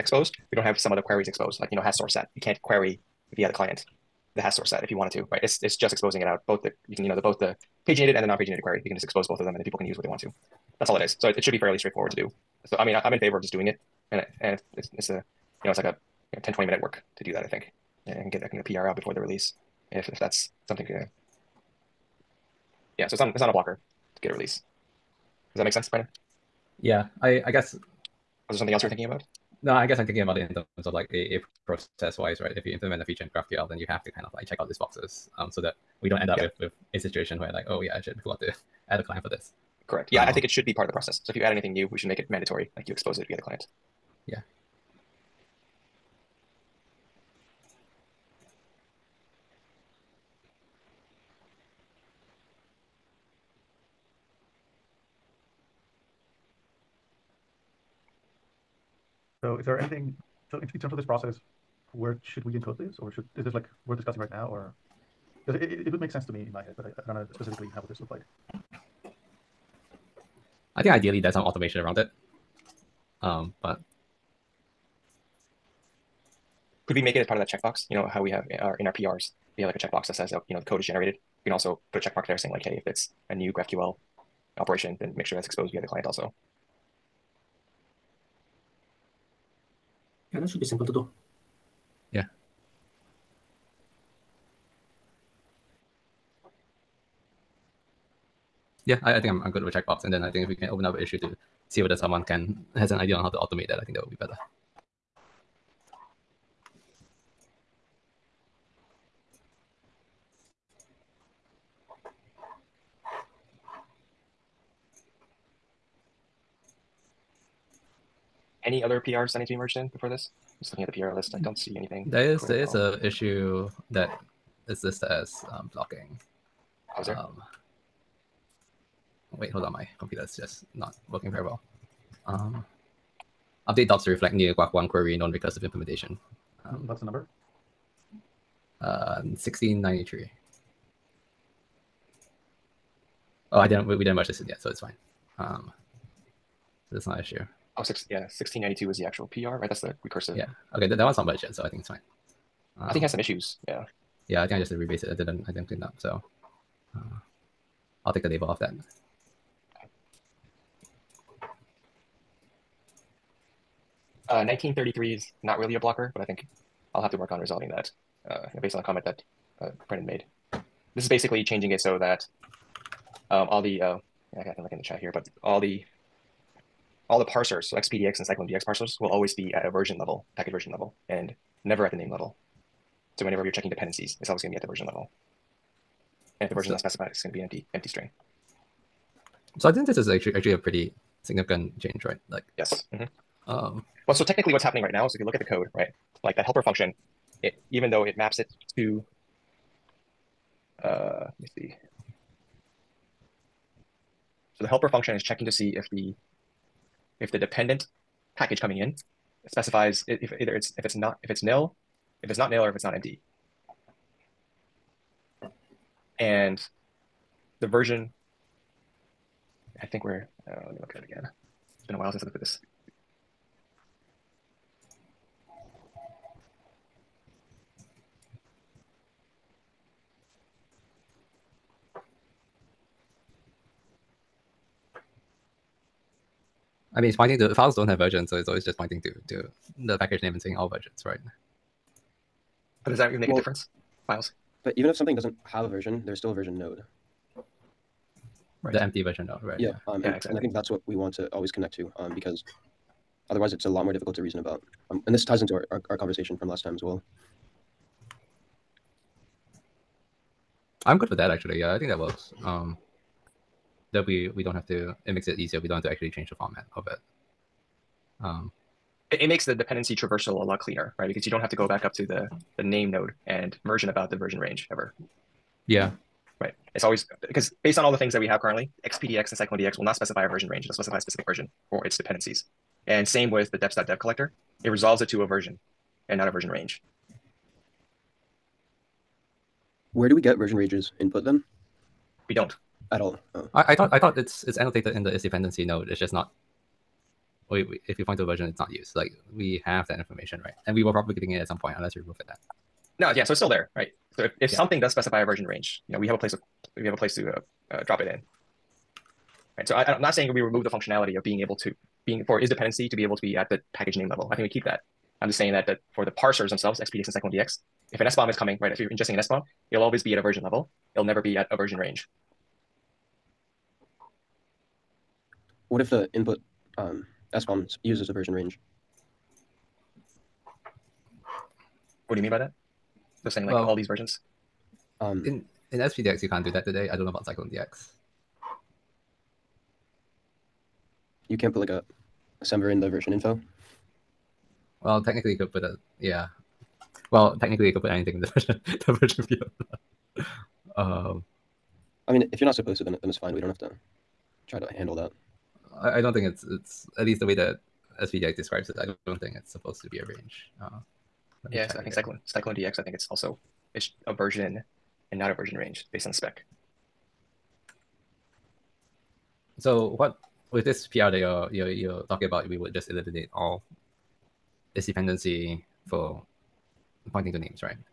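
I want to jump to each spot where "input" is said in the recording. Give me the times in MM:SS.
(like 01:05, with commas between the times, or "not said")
04:51, 05:26.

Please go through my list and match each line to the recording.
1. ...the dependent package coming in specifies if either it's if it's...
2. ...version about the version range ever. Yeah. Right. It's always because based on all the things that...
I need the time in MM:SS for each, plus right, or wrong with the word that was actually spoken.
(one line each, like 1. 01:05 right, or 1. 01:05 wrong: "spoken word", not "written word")
1. 03:27 right
2. 04:33 right.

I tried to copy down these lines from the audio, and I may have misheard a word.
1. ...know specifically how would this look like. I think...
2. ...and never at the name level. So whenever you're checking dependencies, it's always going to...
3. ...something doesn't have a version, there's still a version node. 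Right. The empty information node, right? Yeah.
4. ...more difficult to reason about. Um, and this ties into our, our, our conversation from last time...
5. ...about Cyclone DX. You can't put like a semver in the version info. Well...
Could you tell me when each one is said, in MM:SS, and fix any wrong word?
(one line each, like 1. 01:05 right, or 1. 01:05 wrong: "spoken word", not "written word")
1. 01:07 right
2. 03:01 right
3. 04:04 wrong: "version", not "information"
4. 04:13 right
5. 05:37 right.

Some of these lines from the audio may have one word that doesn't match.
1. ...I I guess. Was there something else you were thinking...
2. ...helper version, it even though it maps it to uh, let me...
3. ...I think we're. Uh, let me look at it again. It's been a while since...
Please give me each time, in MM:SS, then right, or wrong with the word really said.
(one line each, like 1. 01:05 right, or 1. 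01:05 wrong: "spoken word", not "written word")
1. 00:27 right
2. 03:16 wrong: "function", not "version"
3. 03:39 right.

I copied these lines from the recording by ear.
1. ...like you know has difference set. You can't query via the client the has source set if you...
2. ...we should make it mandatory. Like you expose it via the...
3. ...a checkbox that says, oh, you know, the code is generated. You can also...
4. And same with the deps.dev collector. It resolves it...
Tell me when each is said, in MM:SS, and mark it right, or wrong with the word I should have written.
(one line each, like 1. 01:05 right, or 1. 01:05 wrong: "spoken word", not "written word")
1. 00:01 wrong: "source", not "difference"
2. 00:41 right
3. 01:19 right
4. 04:42 right.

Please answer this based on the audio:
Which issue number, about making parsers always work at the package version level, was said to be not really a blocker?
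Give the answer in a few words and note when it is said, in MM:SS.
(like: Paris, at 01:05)
1933, at 02:44.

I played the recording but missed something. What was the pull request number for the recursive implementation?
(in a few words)
1692.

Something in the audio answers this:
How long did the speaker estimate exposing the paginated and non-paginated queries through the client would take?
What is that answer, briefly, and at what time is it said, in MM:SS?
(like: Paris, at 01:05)
10 20 minutes, at 00:16.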